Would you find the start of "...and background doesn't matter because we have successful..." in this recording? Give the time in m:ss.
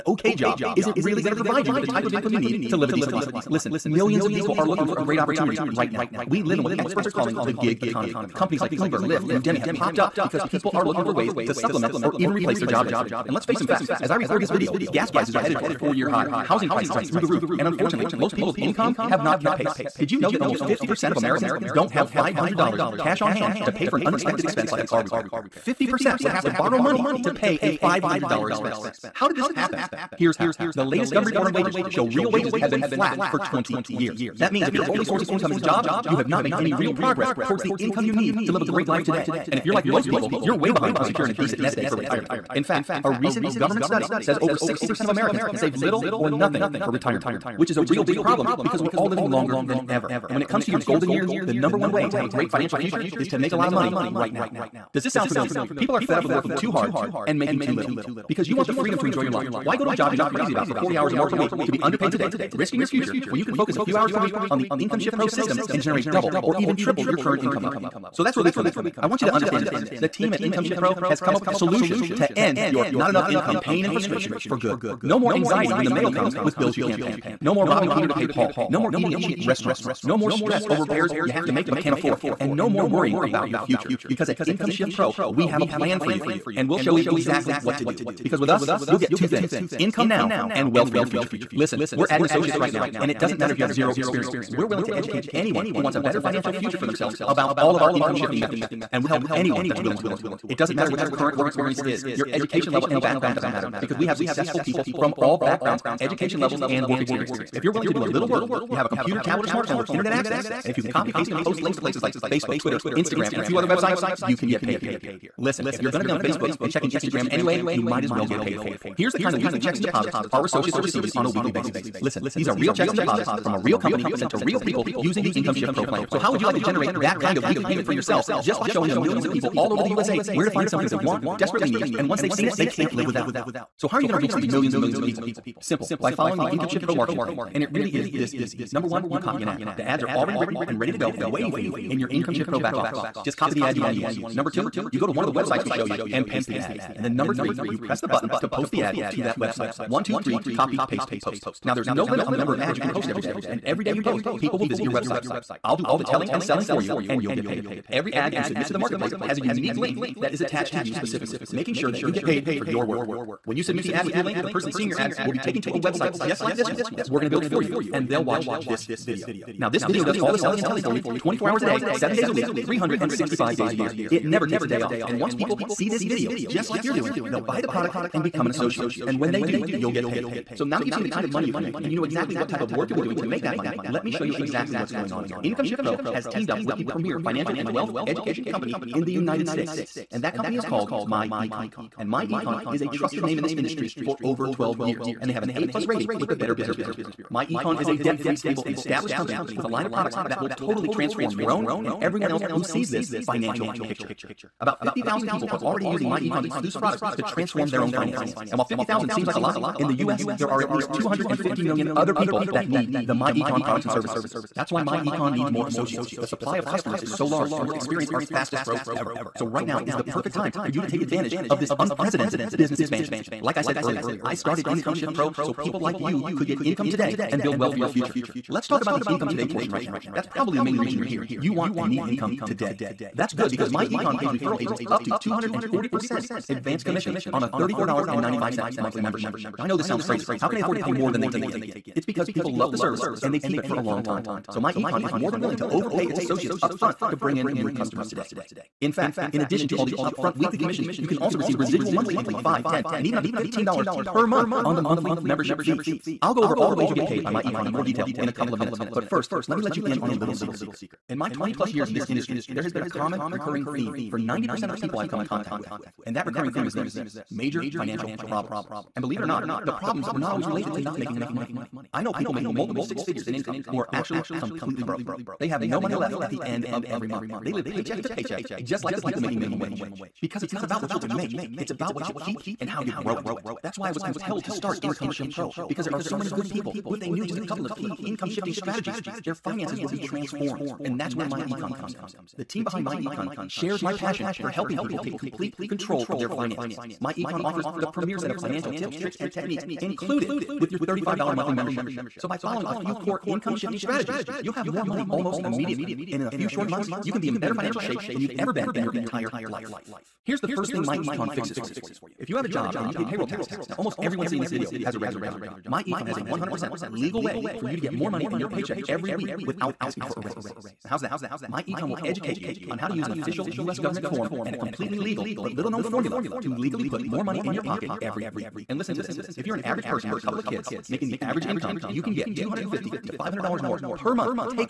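1:42.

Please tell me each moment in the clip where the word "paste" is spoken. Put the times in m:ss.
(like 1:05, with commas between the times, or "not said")
1:51, 2:26, 2:30.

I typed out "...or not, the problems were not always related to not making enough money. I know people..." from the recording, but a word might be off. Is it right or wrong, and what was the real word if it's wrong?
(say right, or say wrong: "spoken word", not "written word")
right.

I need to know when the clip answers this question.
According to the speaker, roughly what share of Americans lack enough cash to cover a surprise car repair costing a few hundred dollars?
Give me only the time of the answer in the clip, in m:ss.
0:20.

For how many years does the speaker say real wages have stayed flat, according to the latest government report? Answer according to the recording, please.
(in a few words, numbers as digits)
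20 years.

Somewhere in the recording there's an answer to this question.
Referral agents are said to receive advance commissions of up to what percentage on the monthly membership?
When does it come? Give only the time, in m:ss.
3:55.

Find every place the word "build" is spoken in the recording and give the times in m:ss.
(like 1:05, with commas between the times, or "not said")
2:47, 3:47.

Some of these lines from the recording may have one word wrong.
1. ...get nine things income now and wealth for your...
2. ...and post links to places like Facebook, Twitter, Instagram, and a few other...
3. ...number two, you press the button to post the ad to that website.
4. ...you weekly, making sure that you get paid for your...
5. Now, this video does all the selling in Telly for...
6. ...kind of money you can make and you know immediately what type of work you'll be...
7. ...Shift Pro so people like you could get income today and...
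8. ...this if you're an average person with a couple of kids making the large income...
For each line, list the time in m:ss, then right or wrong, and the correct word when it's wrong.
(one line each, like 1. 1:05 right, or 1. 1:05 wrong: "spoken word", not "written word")
1. 1:28 wrong: "two", not "nine"
2. 1:51 right
3. 2:27 wrong: "three", not "two"
4. 2:40 wrong: "specifically", not "weekly"
5. 2:49 right
6. 3:01 wrong: "exactly", not "immediately"
7. 3:44 right
8. 5:29 wrong: "average", not "large".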